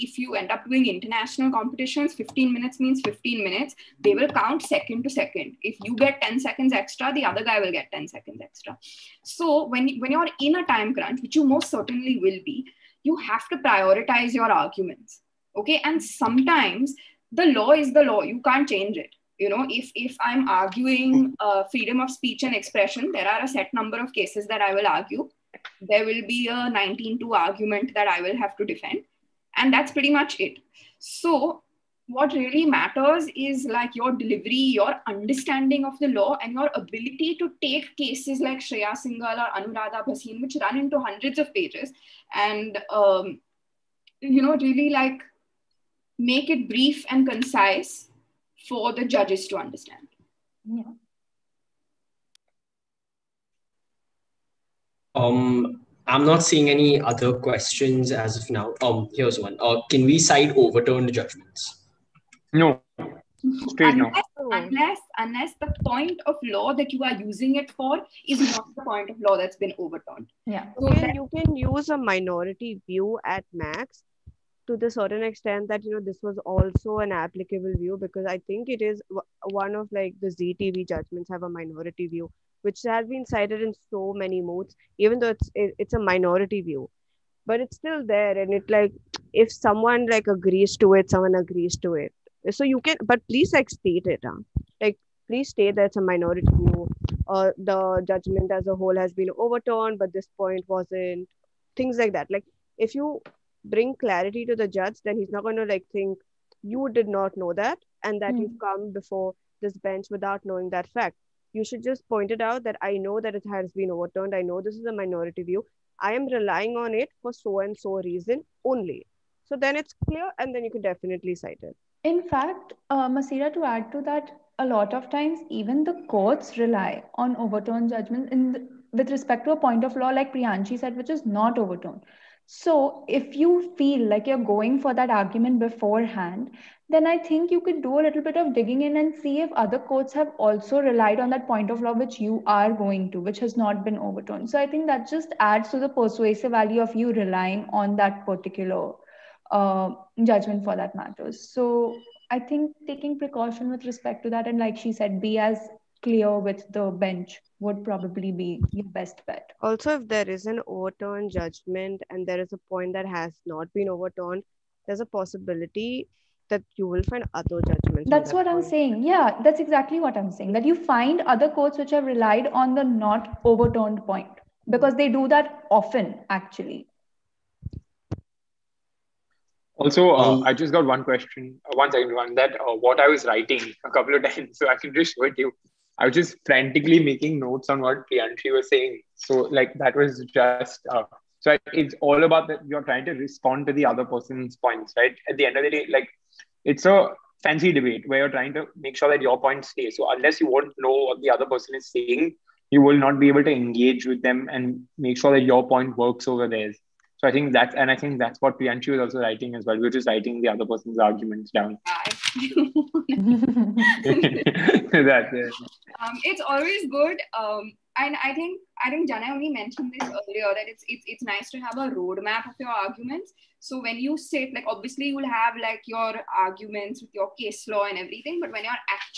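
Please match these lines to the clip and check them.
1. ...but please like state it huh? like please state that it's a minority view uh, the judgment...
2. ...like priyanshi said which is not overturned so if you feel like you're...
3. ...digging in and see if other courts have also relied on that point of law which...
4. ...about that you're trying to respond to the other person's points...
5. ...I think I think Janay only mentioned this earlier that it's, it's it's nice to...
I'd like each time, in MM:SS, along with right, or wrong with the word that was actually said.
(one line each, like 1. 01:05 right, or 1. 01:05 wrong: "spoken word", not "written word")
1. 01:33 right
2. 02:10 right
3. 02:18 right
4. 03:12 right
5. 03:38 right.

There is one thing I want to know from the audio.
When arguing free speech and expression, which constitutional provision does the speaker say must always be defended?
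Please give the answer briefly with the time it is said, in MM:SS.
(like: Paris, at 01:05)
19(2), at 00:26.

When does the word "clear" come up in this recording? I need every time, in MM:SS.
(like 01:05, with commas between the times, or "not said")
02:00, 02:36.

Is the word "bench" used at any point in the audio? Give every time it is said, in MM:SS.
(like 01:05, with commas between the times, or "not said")
01:49, 02:36.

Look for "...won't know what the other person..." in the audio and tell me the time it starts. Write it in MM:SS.
03:20.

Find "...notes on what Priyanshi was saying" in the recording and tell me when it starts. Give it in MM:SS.
03:07.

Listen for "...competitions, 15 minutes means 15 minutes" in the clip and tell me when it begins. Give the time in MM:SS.
00:01.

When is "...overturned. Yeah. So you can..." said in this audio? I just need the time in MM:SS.
01:09.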